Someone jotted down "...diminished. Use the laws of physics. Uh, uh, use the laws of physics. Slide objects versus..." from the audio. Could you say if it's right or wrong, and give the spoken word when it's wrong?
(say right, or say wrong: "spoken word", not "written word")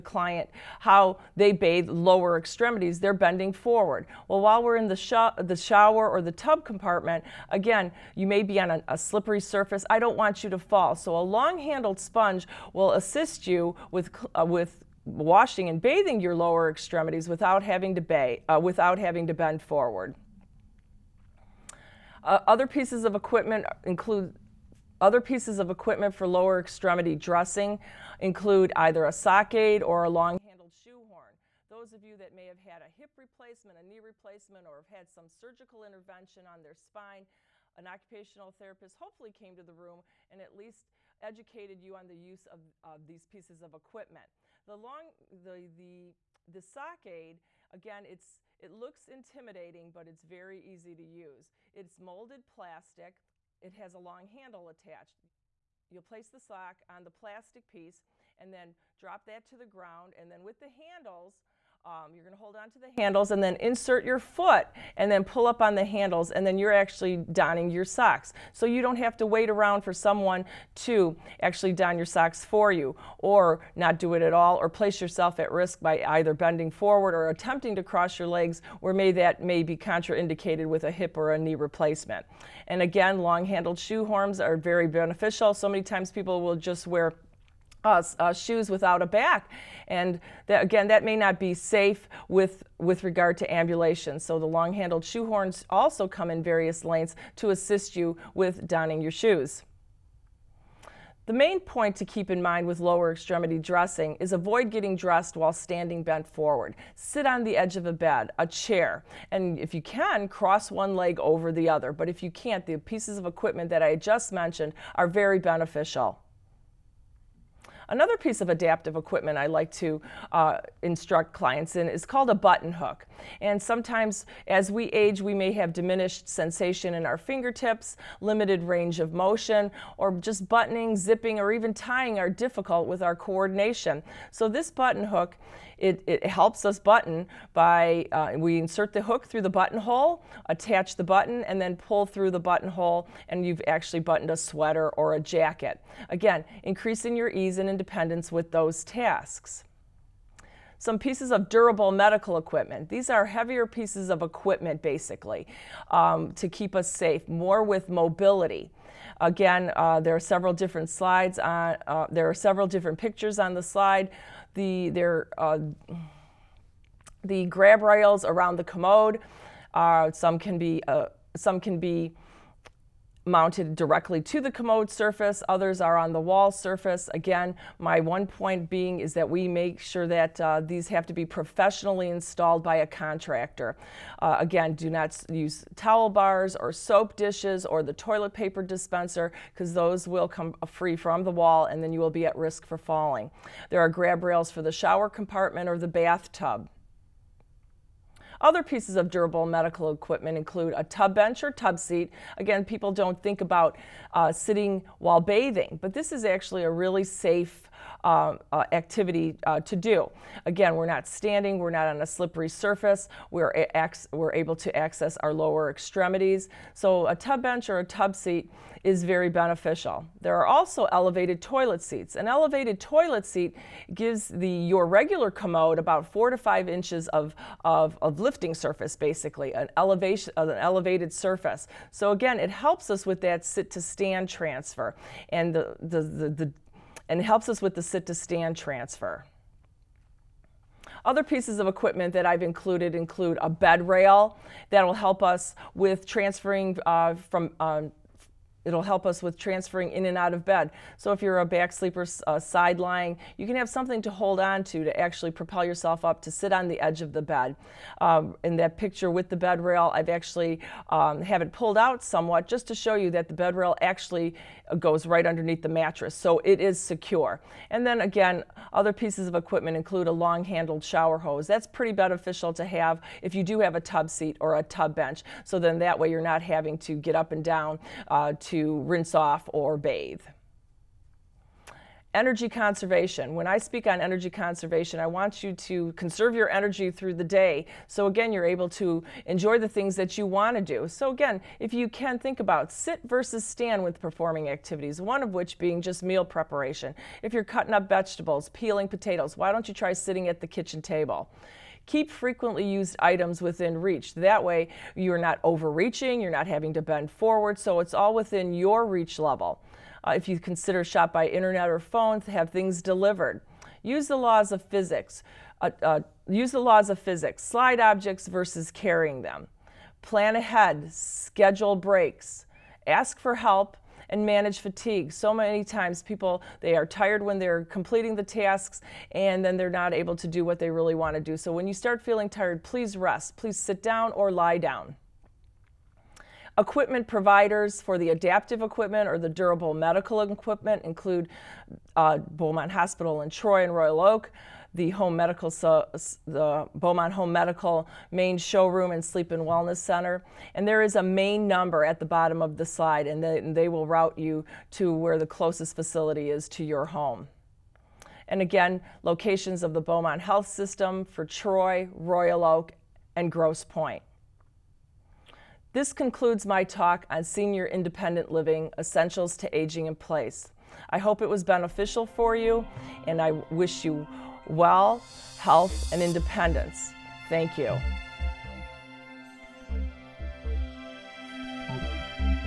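wrong: "delivered", not "diminished".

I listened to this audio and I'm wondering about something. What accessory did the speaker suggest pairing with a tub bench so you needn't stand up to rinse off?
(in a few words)
Long handled shower hose.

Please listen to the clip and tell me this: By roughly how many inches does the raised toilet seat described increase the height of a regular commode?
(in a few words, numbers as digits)
4 to 5 inches.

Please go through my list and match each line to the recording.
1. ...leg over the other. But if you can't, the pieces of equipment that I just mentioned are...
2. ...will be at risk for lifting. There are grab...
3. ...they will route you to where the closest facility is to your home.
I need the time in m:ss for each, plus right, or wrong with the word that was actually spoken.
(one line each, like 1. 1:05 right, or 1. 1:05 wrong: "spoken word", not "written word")
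1. 1:50 right
2. 3:11 wrong: "falling", not "lifting"
3. 5:53 right.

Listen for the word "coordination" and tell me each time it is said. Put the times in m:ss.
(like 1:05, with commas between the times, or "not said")
2:13.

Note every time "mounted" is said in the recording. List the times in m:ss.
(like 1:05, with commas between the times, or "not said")
2:53.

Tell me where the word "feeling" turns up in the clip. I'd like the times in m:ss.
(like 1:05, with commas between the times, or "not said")
5:32.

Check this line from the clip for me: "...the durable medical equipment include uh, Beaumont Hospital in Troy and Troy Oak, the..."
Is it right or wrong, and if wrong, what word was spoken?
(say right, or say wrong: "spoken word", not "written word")
wrong: "Royal", not "Troy".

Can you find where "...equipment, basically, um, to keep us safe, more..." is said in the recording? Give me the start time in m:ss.
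2:34.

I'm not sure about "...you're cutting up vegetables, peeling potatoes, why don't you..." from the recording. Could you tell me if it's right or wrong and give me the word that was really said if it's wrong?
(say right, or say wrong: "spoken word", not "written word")
right.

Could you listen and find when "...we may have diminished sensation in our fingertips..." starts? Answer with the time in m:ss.
2:05.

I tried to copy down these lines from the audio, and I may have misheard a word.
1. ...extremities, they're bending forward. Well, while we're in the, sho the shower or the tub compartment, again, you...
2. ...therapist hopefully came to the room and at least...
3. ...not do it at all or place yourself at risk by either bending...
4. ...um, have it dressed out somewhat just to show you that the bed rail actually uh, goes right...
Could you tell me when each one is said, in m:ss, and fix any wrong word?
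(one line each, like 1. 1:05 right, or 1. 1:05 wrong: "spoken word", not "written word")
1. 0:02 right
2. 0:38 right
3. 1:13 right
4. 4:20 wrong: "pulled", not "dressed".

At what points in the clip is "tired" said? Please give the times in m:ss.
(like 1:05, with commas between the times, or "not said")
5:26, 5:32.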